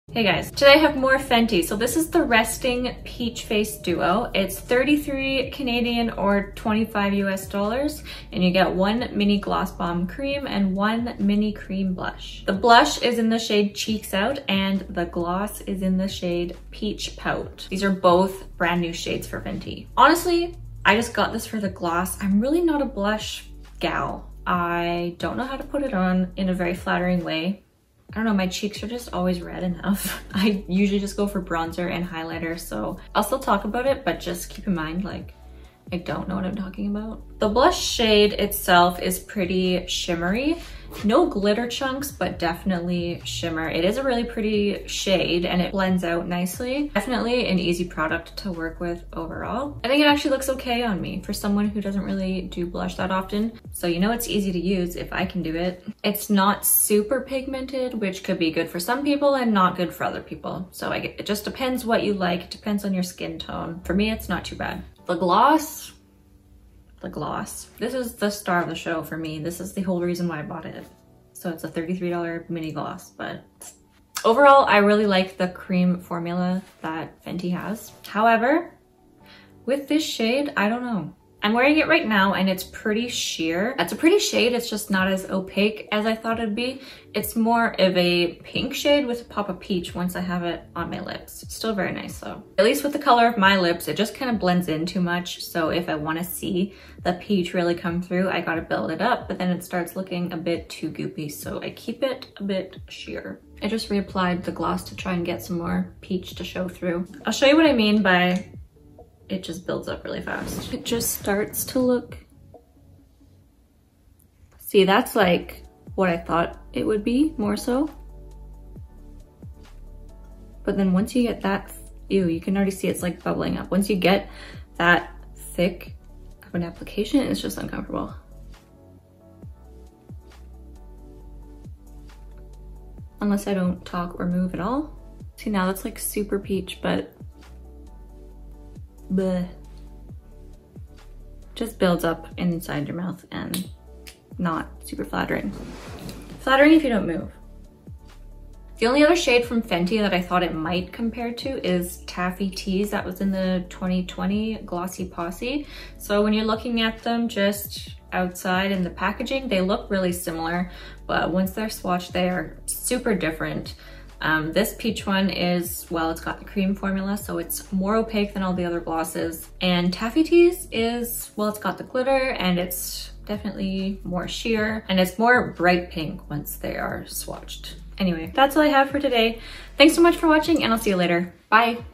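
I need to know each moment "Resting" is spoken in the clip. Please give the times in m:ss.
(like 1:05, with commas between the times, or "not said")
0:02.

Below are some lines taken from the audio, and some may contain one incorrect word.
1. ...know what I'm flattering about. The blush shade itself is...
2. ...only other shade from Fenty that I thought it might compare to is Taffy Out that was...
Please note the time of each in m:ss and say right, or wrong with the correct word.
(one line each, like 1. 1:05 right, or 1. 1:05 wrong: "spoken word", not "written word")
1. 0:36 wrong: "talking", not "flattering"
2. 2:28 wrong: "Tease", not "Out".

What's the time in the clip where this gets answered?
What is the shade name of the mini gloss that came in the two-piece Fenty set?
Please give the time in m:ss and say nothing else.
0:16.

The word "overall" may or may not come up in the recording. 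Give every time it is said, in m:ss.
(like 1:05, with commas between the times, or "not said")
0:49, 1:14.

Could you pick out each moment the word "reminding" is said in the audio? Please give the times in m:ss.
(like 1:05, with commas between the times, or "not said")
not said.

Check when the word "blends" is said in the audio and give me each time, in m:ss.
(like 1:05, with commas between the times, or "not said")
0:45, 1:34.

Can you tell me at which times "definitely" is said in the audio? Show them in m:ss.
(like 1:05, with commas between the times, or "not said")
0:42, 0:46, 2:53.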